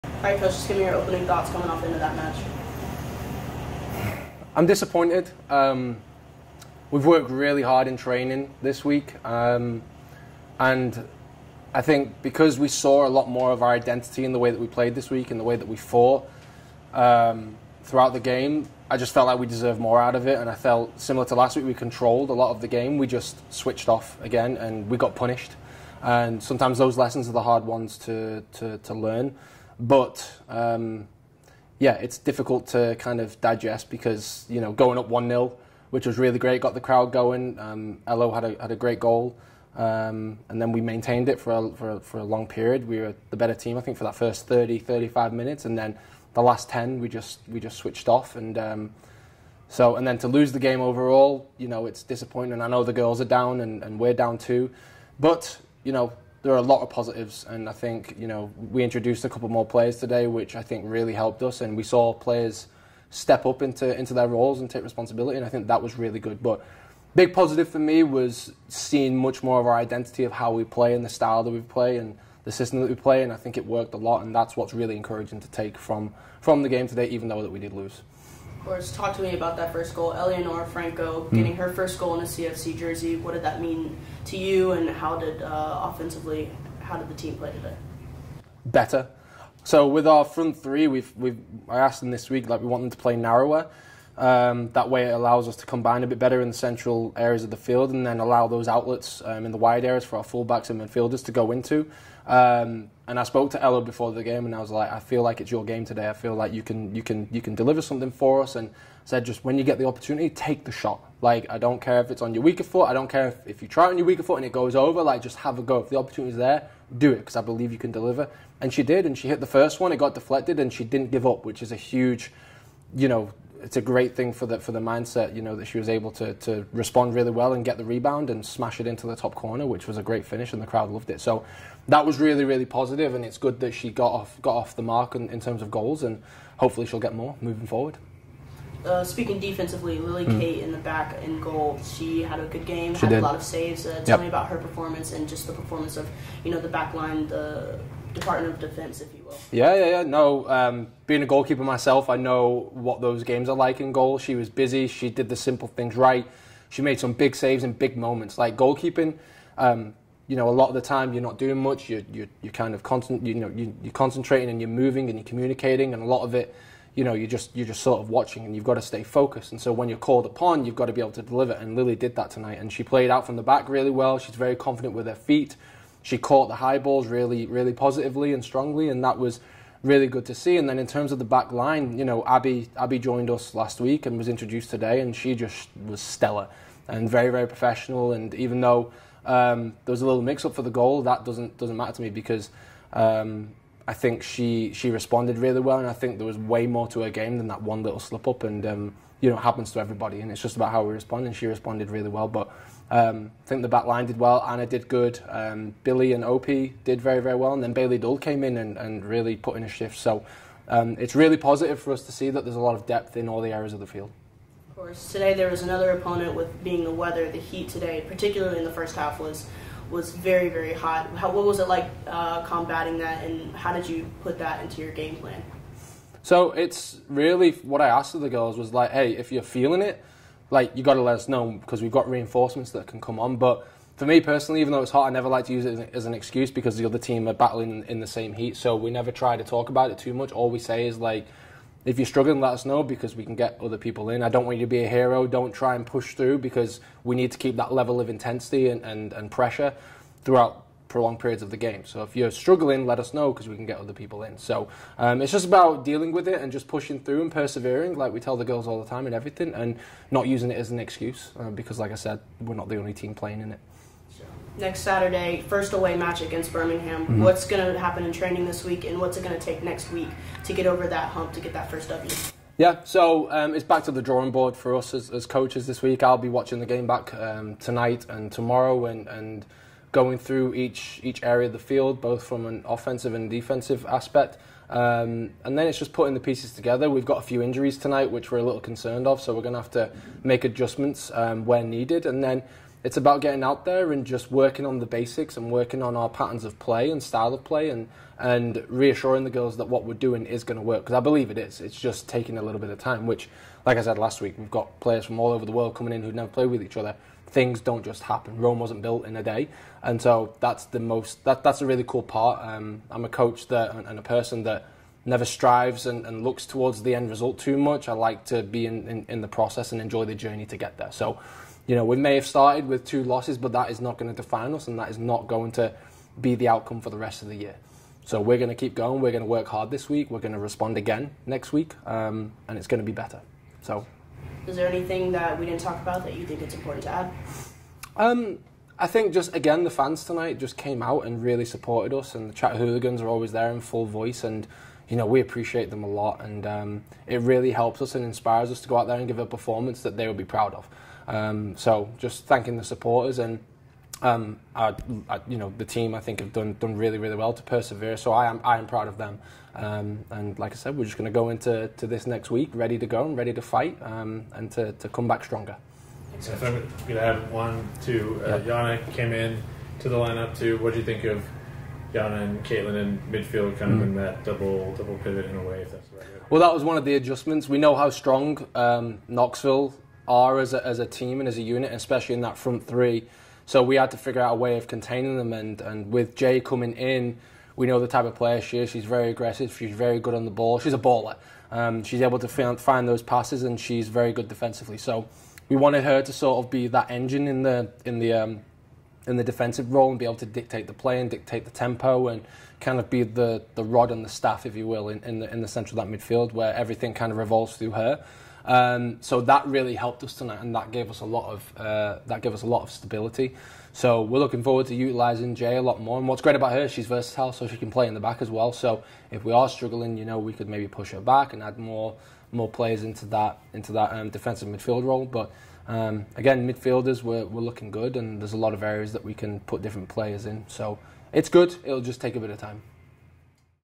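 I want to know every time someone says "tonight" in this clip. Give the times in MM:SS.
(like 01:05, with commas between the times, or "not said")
02:52, 04:37, 04:47, 05:40, 06:50.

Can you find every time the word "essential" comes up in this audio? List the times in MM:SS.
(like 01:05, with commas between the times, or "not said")
not said.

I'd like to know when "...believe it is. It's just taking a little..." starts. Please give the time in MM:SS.
05:00.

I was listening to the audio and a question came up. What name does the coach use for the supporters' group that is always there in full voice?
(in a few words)
Chattahooligans.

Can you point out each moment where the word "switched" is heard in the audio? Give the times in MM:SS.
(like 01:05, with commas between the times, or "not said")
00:23, 00:47.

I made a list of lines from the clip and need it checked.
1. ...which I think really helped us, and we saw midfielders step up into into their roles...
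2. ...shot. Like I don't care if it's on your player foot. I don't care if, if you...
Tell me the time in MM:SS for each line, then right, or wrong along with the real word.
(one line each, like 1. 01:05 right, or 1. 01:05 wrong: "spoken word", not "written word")
1. 01:00 wrong: "players", not "midfielders"
2. 01:50 wrong: "weaker", not "player".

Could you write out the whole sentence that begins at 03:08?
And even though um, there was a little mix up for the goal, that doesn't doesn't matter to me because.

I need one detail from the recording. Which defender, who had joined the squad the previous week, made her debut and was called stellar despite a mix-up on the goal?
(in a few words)
Abby.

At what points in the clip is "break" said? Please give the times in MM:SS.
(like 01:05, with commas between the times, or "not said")
not said.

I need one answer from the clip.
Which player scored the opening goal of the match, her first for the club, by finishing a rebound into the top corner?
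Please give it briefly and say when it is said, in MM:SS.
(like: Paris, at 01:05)
Eleanor Franco, at 01:20.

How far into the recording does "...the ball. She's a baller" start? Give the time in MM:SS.
06:30.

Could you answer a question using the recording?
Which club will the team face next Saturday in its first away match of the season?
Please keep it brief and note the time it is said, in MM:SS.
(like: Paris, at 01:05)
Birmingham, at 04:26.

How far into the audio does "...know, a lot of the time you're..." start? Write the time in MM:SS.
02:40.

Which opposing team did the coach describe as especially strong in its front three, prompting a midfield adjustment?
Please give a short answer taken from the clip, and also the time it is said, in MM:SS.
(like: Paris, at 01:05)
Knoxville, at 06:19.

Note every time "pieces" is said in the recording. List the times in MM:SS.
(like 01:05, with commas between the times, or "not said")
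04:46.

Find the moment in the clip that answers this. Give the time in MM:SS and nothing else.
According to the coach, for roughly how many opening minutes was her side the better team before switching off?
00:44.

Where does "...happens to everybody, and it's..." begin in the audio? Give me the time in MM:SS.
03:19.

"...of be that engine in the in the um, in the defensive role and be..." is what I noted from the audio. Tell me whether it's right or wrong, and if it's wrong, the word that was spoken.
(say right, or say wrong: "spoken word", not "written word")
right.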